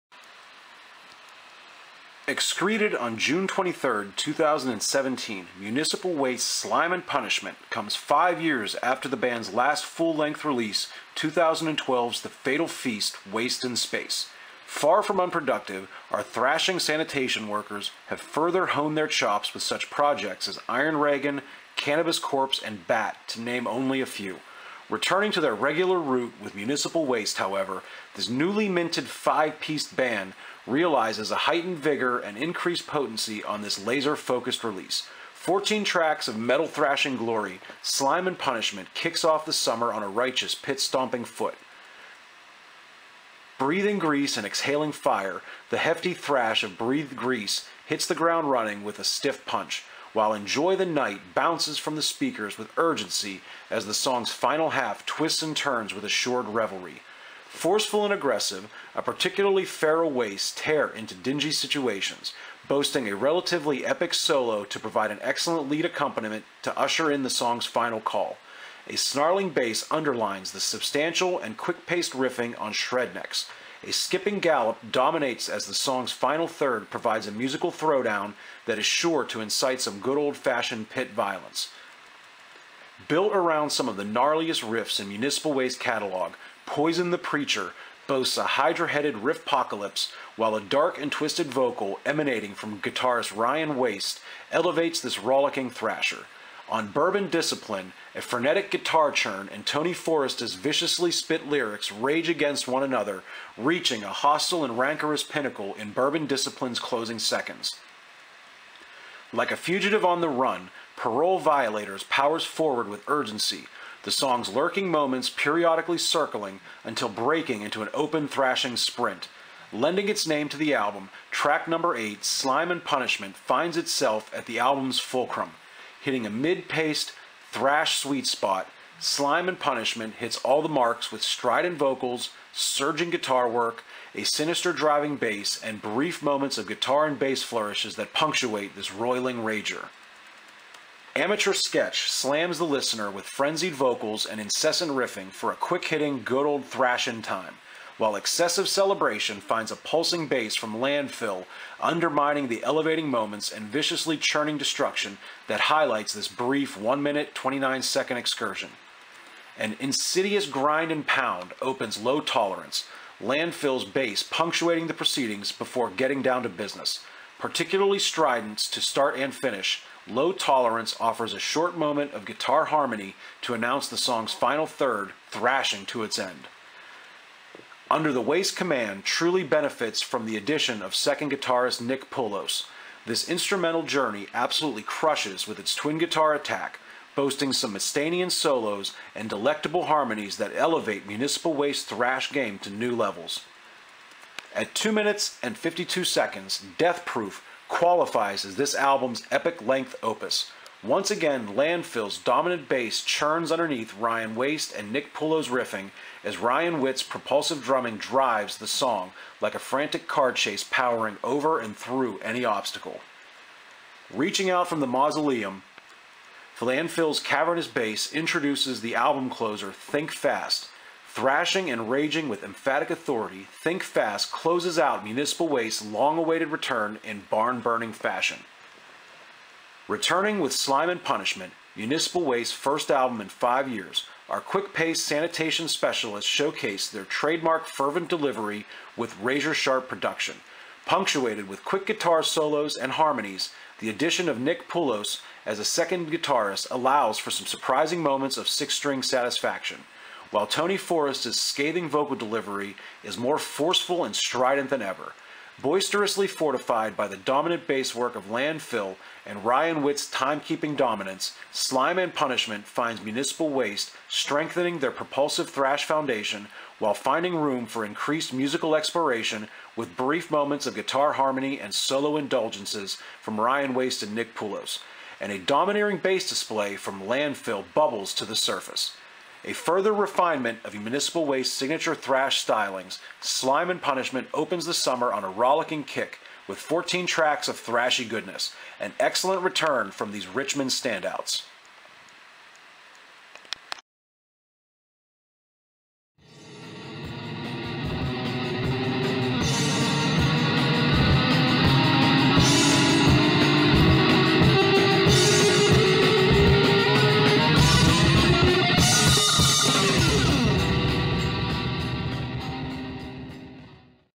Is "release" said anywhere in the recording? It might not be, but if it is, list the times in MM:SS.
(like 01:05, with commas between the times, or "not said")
00:10, 00:34.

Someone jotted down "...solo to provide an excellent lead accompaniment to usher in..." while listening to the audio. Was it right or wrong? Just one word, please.
right.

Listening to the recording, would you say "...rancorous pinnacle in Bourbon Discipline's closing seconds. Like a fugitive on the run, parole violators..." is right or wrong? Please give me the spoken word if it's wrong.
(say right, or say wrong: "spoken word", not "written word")
right.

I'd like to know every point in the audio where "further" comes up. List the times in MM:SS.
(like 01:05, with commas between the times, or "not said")
00:18, 04:39.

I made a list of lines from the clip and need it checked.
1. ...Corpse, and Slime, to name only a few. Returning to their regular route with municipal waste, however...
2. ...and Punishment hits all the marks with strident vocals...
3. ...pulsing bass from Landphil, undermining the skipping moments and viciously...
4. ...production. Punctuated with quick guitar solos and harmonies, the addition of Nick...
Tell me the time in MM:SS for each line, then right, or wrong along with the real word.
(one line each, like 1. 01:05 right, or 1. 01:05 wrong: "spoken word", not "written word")
1. 00:22 wrong: "Bat", not "Slime"
2. 02:09 right
3. 02:29 wrong: "elevating", not "skipping"
4. 03:59 right.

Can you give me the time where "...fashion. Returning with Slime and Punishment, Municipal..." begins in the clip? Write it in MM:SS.
03:47.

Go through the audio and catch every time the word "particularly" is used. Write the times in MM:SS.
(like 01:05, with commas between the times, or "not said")
00:59, 02:47.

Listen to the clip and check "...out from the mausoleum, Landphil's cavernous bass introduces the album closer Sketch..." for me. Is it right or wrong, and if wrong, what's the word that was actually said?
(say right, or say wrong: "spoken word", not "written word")
wrong: "Think", not "Sketch".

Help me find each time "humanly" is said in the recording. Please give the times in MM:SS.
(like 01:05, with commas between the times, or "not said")
not said.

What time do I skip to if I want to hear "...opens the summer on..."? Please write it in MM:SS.
04:44.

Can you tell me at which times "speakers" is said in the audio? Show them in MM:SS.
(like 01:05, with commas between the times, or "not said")
00:52.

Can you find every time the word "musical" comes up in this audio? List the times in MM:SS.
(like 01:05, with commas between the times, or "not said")
01:17, 04:28.